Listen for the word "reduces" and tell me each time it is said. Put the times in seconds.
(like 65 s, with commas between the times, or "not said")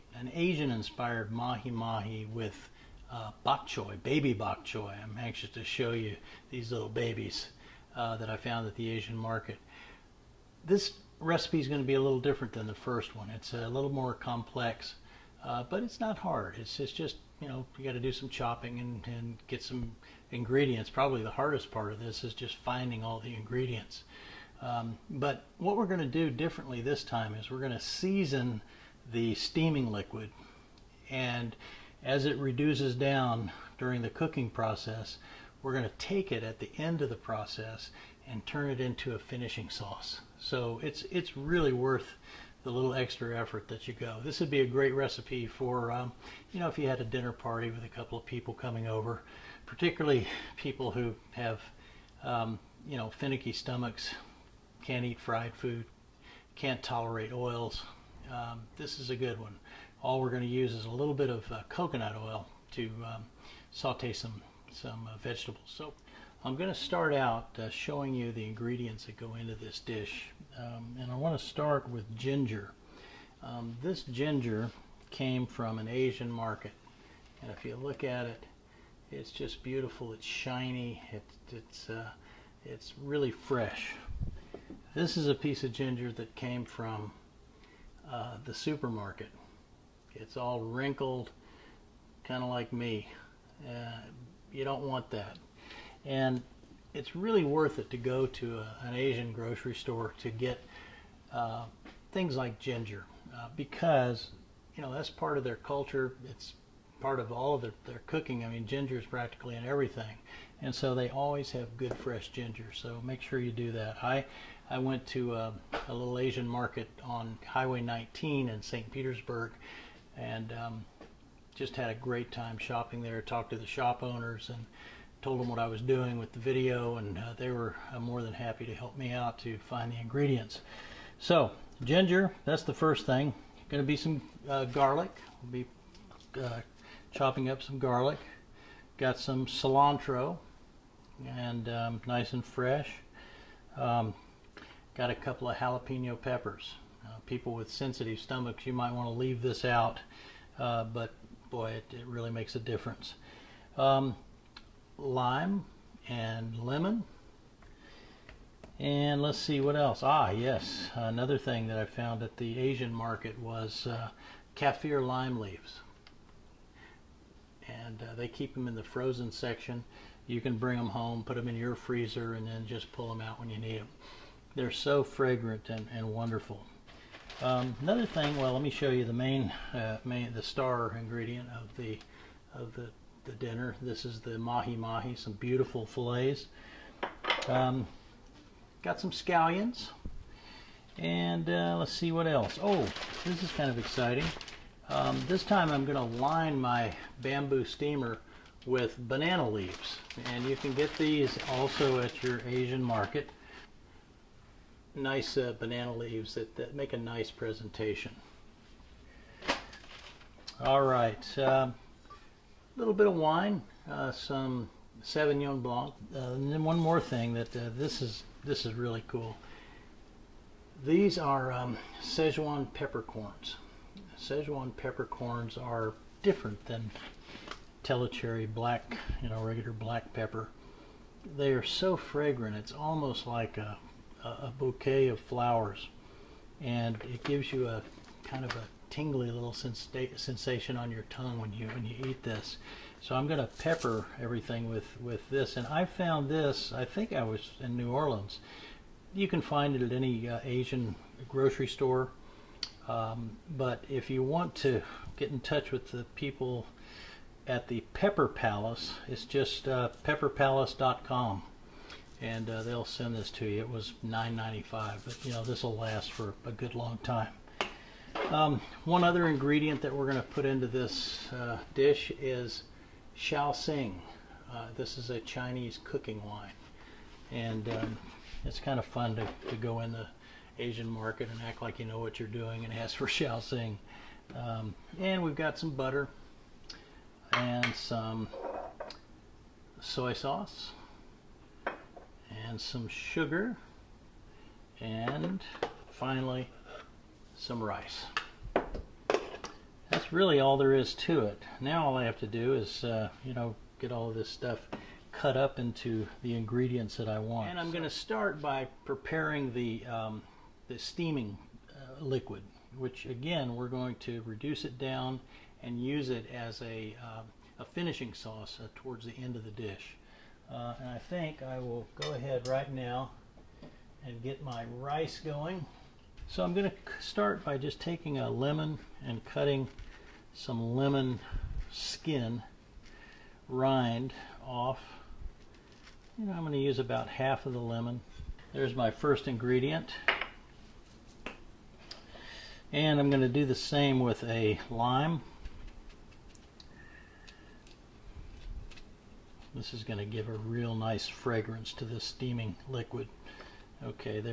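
32 s, 314 s.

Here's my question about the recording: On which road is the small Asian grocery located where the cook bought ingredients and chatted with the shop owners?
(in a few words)
Highway 19.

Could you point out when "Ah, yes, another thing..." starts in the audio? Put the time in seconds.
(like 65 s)
160 s.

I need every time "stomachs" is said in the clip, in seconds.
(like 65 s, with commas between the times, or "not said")
53 s, 148 s.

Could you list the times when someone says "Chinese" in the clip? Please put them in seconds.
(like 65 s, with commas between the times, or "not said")
275 s.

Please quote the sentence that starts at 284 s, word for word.
Um, and we've got some butter and some soy sauce and some sugar and finally some rice.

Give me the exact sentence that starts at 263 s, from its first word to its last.
It was $9.95, but you know this will last for a good long time.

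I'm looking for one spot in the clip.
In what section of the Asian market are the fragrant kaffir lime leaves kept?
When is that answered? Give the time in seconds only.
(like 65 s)
168 s.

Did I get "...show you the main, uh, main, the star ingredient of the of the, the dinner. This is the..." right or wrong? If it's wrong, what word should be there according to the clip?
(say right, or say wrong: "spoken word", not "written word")
right.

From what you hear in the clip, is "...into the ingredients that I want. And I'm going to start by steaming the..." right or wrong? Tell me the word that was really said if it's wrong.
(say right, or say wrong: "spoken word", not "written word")
wrong: "preparing", not "steaming".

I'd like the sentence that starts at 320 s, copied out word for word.
Uh, and I think I will go ahead right now and get my rice going.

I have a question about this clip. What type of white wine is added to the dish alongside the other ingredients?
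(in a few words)
Sauvignon Blanc.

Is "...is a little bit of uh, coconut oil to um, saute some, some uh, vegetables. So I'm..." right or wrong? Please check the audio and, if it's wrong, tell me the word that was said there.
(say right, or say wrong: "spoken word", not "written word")
right.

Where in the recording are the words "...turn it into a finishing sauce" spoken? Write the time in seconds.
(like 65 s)
38 s.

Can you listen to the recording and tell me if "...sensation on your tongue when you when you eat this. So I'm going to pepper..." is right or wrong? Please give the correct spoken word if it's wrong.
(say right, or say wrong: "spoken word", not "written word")
right.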